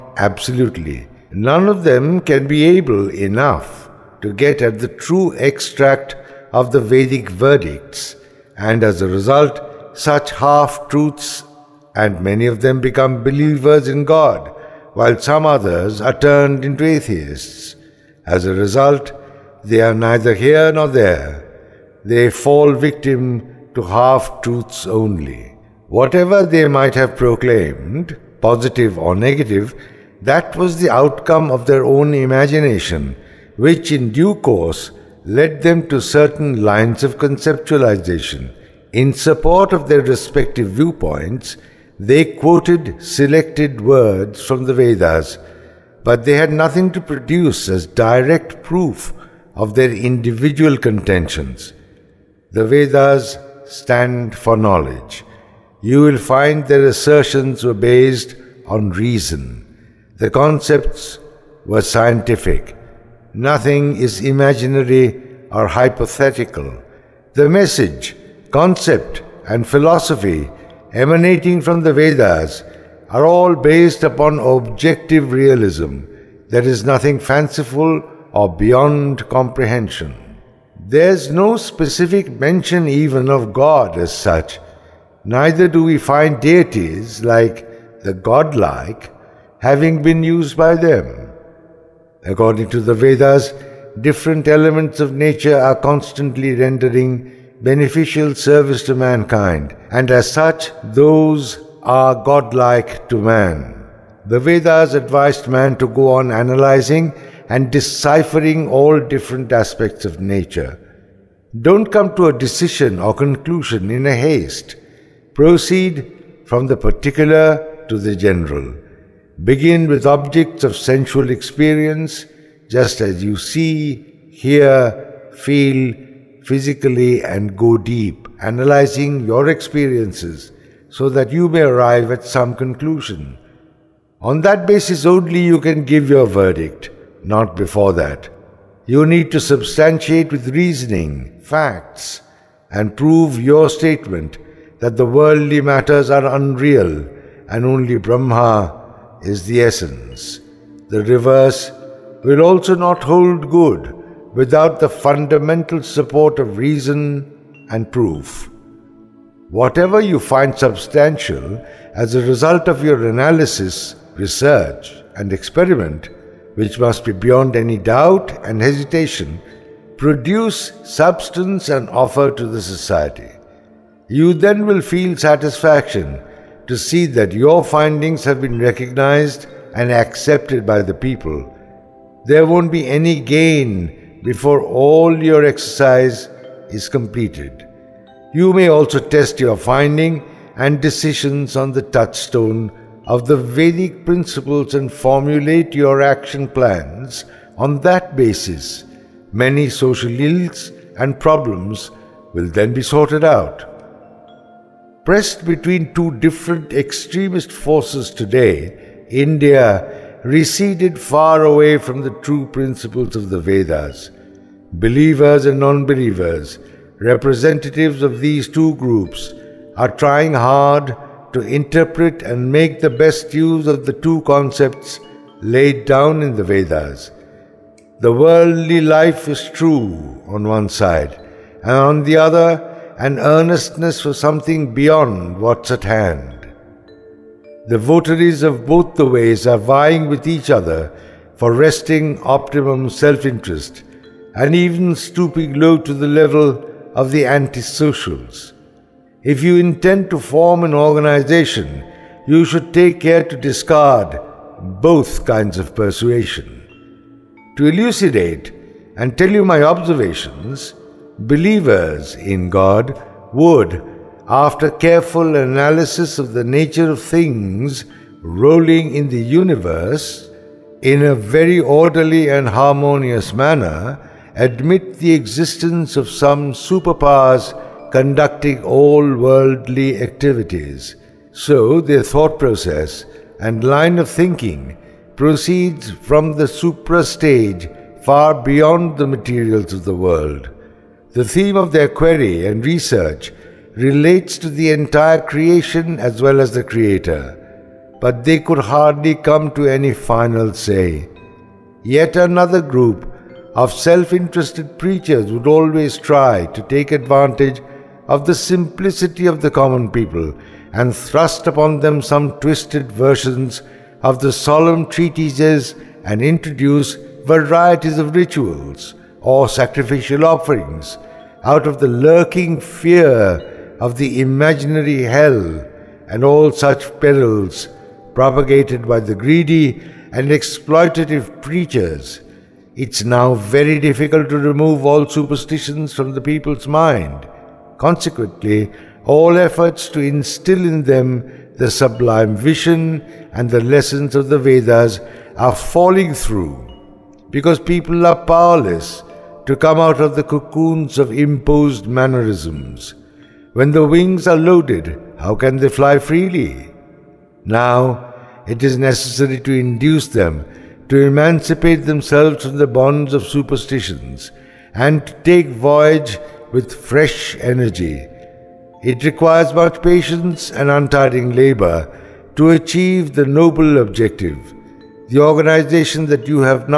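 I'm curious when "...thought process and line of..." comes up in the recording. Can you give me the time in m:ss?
4:42.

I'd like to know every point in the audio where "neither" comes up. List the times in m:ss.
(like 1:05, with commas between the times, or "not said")
0:19, 1:25.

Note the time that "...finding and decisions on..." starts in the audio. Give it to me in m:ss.
3:09.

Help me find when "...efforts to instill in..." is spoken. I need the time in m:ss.
5:39.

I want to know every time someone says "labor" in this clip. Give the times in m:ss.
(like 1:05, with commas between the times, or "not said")
6:11.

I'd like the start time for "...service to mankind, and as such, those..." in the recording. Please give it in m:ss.
1:38.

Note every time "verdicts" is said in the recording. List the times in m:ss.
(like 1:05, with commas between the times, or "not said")
0:07, 2:16.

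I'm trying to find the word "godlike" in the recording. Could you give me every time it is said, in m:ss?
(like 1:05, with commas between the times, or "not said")
1:28, 1:42.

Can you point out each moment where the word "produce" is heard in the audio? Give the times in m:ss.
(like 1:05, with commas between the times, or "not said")
0:47, 2:49.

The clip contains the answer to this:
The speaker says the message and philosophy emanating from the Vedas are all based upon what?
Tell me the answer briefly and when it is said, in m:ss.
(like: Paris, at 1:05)
Objective realism, at 1:14.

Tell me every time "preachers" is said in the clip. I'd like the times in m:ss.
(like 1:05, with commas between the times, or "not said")
5:04, 5:31.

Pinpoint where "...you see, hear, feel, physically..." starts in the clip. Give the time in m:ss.
2:03.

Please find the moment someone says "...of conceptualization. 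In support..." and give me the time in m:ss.
0:37.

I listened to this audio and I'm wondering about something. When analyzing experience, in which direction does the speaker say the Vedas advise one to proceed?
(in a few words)
From the particular to the general.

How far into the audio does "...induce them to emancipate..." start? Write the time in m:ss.
5:59.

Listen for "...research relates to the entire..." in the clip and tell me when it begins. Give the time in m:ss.
4:52.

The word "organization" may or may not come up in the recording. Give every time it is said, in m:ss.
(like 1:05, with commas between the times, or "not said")
4:10, 6:15.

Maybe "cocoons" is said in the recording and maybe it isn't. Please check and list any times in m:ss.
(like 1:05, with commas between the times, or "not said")
5:50.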